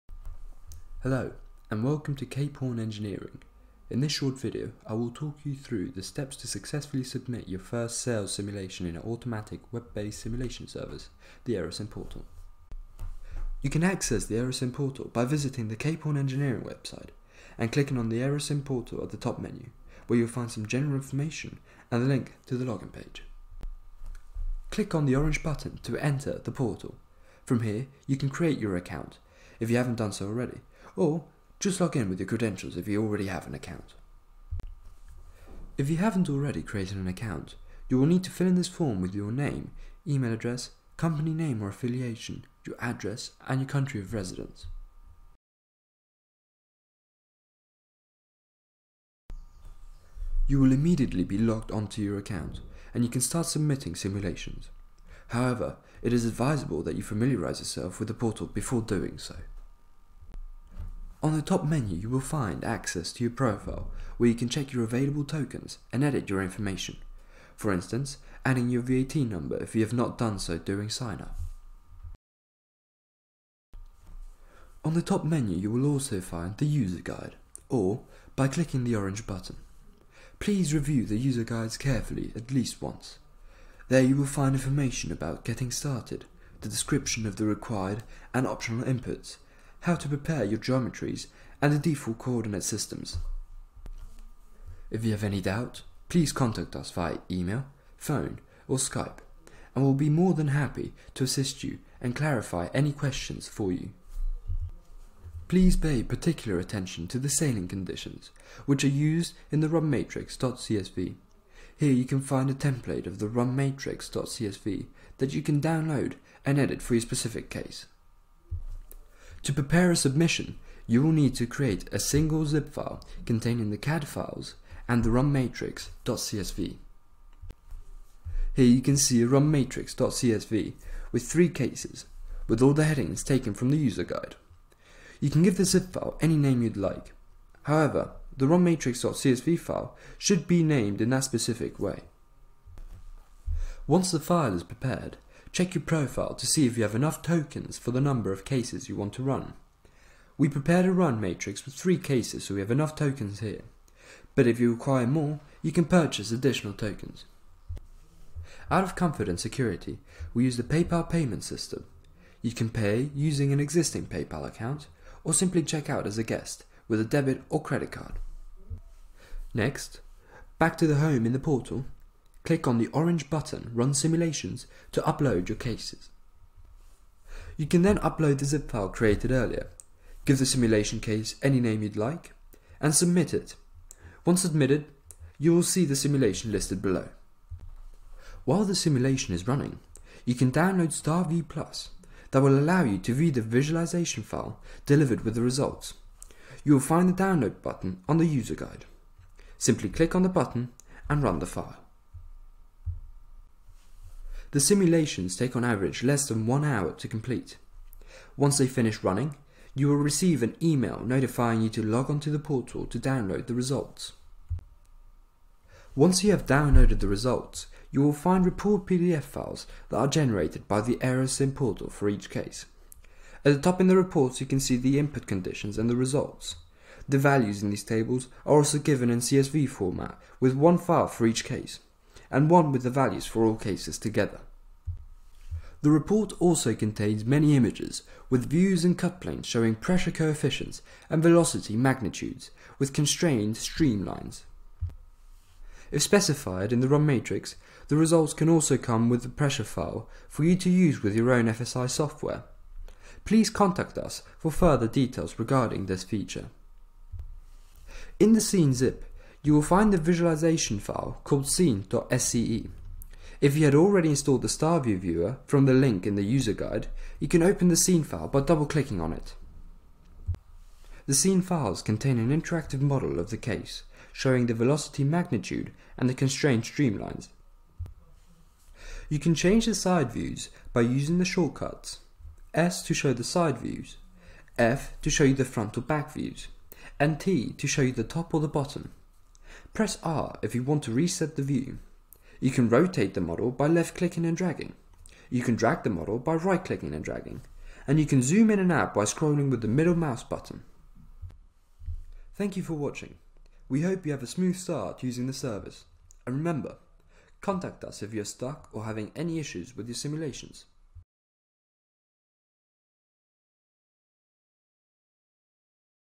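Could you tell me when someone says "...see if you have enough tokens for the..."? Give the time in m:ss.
2:26.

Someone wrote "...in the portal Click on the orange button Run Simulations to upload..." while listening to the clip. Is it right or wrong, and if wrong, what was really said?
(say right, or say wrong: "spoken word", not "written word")
right.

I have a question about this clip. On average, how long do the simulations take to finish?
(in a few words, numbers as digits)
less than one hour.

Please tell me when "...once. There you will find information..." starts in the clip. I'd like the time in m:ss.
1:22.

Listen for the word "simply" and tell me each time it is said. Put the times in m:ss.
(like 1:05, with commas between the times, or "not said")
2:45, 3:19.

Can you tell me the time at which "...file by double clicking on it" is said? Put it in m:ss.
4:28.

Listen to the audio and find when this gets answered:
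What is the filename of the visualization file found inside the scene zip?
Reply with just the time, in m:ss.
4:21.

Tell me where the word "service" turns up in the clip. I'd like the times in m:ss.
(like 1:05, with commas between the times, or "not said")
0:10, 5:05.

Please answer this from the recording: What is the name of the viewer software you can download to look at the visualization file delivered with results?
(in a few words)
StarView Plus.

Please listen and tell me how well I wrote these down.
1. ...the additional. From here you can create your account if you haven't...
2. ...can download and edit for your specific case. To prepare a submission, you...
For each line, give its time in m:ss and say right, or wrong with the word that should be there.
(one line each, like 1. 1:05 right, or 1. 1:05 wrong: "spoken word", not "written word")
1. 0:26 wrong: "portal", not "additional"
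2. 1:55 right.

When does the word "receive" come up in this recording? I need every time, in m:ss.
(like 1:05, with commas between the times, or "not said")
3:29.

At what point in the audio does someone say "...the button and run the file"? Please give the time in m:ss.
3:20.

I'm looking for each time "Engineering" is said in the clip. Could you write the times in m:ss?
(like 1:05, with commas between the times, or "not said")
0:02, 0:16.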